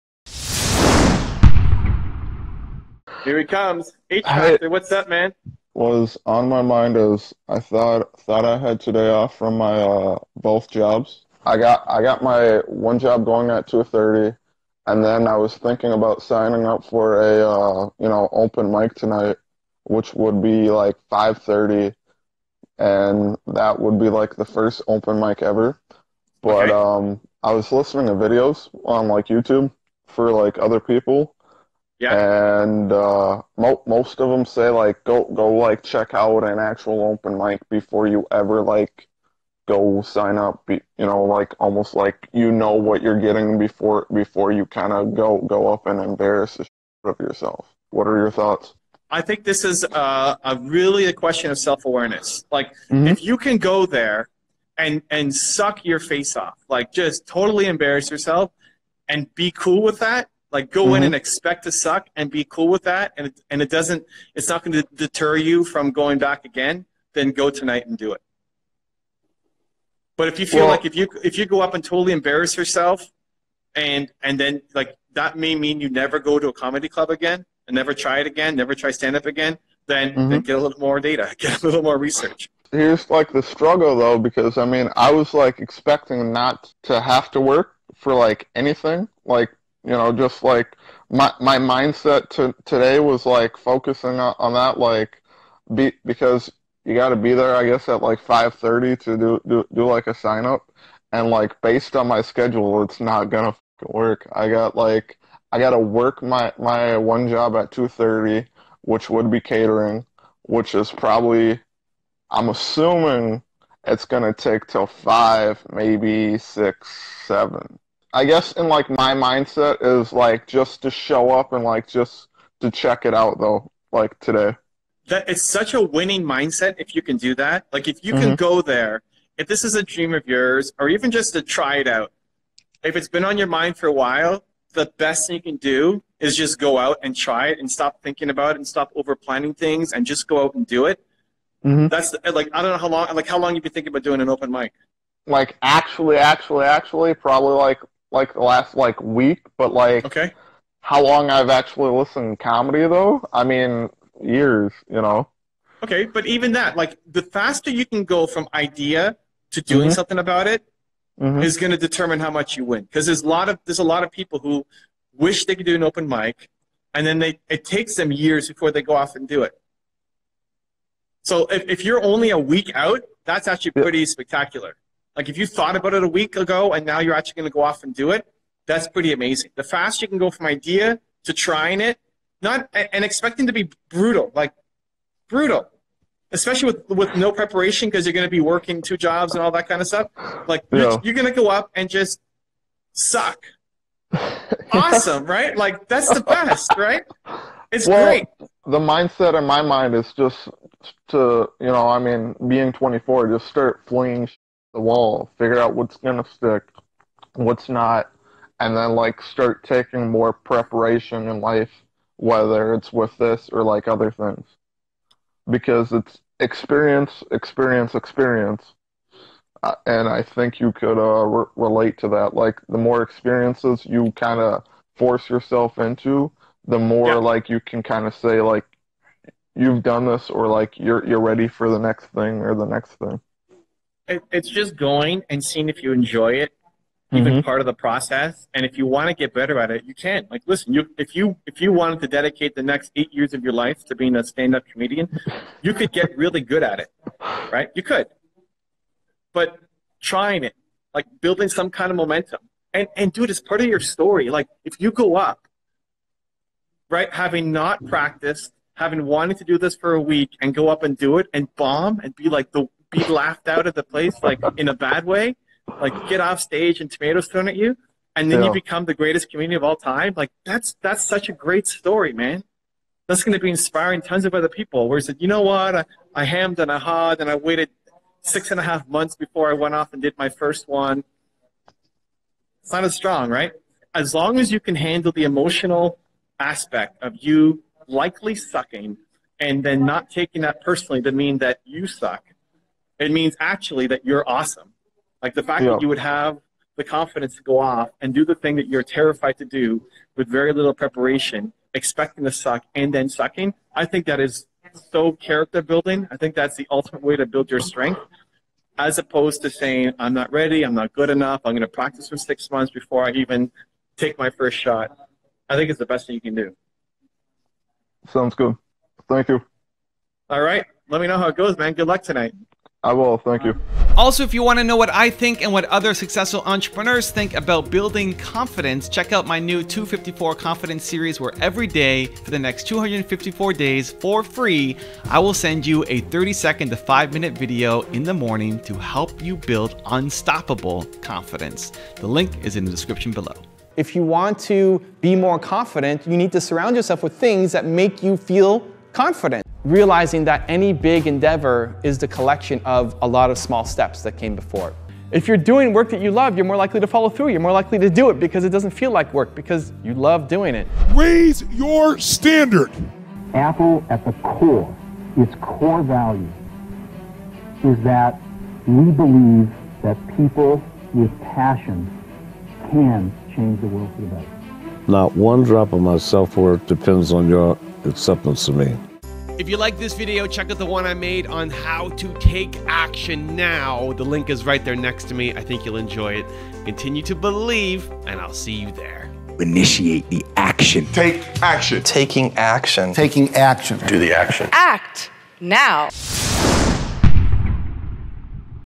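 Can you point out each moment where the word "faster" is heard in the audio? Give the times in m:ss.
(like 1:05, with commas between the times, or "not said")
2:37, 2:59.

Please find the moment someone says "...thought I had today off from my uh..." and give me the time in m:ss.
0:08.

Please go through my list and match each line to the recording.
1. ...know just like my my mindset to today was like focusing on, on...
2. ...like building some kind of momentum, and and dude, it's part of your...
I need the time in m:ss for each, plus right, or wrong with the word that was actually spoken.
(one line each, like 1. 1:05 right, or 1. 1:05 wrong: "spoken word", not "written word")
1. 1:29 right
2. 4:10 right.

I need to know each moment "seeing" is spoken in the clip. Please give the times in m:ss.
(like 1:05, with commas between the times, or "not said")
3:55.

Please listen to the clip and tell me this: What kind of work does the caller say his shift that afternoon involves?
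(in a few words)
Catering.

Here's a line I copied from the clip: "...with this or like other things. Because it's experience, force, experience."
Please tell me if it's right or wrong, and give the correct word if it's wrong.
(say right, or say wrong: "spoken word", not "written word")
wrong: "experience", not "force".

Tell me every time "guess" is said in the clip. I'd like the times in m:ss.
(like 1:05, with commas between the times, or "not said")
1:37, 1:58.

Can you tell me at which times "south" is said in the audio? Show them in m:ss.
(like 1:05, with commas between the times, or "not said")
not said.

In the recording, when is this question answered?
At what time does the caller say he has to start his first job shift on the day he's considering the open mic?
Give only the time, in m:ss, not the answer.
0:13.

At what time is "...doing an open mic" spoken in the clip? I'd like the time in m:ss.
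2:24.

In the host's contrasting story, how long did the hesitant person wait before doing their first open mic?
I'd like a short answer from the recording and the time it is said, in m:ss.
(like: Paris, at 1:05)
6 and a half months, at 4:38.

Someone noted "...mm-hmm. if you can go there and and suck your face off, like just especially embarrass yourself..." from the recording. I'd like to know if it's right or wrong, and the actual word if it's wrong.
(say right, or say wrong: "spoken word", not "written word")
wrong: "totally", not "especially".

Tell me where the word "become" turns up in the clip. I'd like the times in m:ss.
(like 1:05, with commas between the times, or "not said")
4:28.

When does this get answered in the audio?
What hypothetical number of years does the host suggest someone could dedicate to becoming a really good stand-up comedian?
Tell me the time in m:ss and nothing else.
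4:02.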